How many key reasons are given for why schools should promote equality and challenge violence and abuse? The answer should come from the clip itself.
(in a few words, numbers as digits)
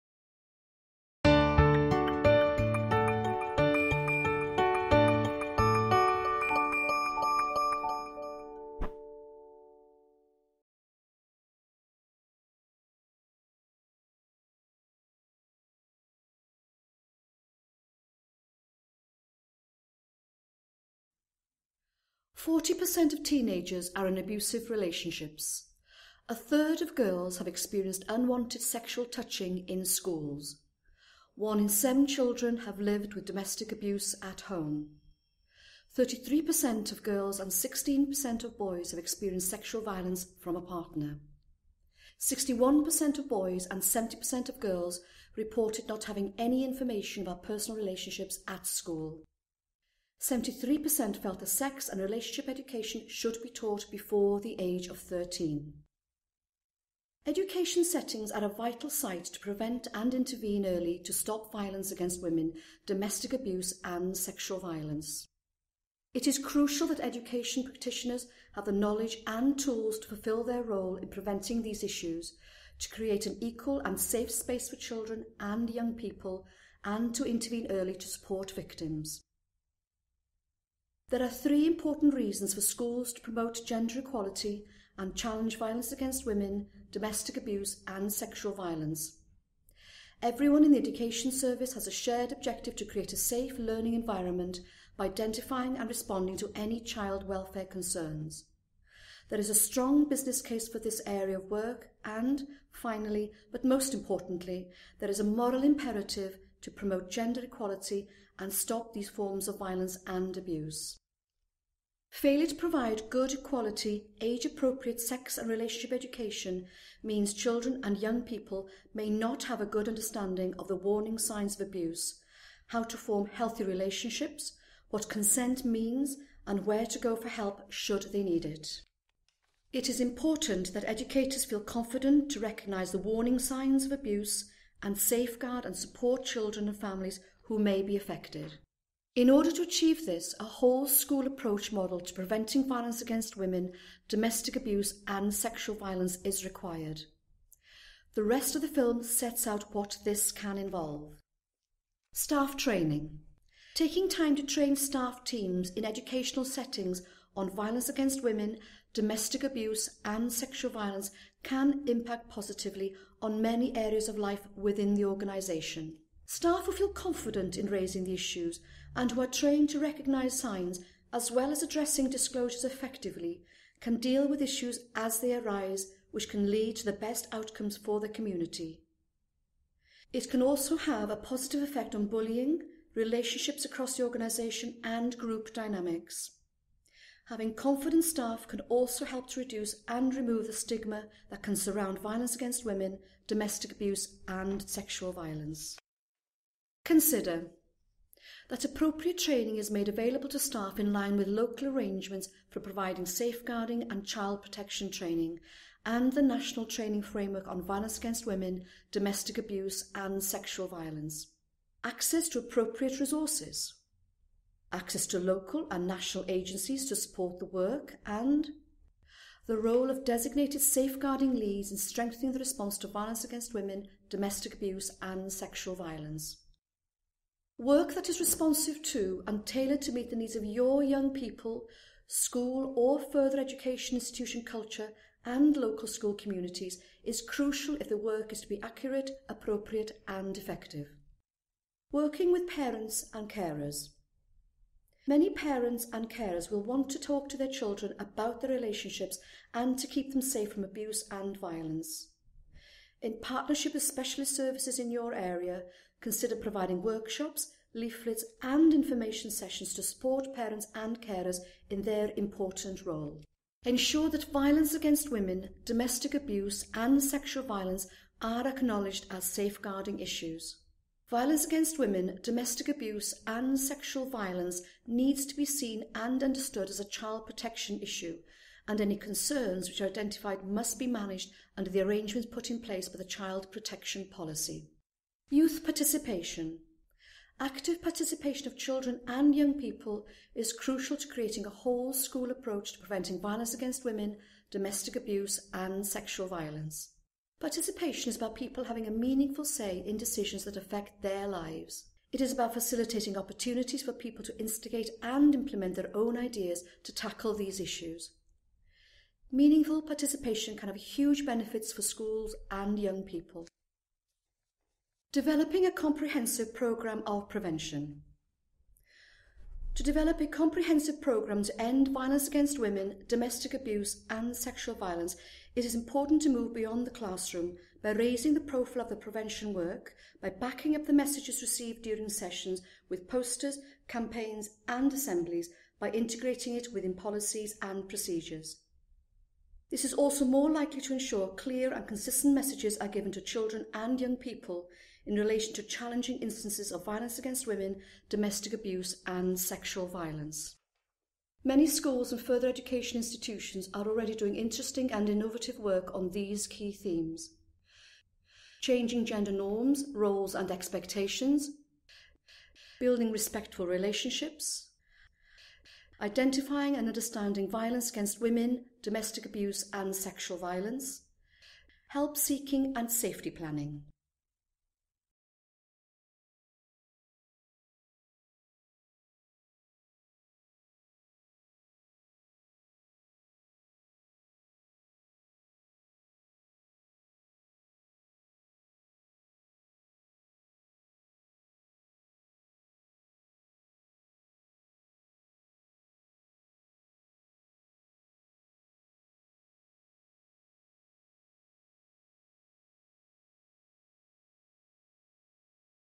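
3.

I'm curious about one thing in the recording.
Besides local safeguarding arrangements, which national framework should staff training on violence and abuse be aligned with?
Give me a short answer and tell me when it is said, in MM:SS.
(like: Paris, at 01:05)
National Training Framework, at 03:26.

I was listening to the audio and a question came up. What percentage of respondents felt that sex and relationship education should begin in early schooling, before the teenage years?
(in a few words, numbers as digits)
73%.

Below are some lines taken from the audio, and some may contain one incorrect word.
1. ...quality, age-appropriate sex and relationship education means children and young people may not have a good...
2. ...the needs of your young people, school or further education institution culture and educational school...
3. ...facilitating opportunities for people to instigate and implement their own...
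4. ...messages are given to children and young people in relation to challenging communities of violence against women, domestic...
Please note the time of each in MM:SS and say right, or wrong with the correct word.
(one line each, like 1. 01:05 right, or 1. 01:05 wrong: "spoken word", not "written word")
1. 01:53 right
2. 03:50 wrong: "local", not "educational"
3. 05:02 right
4. 05:42 wrong: "instances", not "communities".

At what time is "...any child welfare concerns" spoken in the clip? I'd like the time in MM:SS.
01:36.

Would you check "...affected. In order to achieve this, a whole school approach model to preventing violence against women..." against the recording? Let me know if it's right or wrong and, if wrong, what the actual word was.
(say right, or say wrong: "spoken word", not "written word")
right.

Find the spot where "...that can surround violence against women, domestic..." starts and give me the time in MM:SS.
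03:11.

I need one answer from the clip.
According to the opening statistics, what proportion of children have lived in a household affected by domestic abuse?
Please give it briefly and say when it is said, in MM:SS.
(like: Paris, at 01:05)
One in seven, at 00:31.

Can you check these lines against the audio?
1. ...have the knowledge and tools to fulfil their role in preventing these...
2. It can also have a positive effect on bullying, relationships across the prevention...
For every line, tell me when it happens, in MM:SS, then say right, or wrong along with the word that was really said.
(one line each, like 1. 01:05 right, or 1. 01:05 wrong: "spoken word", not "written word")
1. 01:08 right
2. 03:00 wrong: "organisation", not "prevention".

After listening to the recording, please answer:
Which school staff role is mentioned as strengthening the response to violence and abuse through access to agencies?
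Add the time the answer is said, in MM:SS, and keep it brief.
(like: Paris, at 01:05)
Designated safeguarding leads, at 03:40.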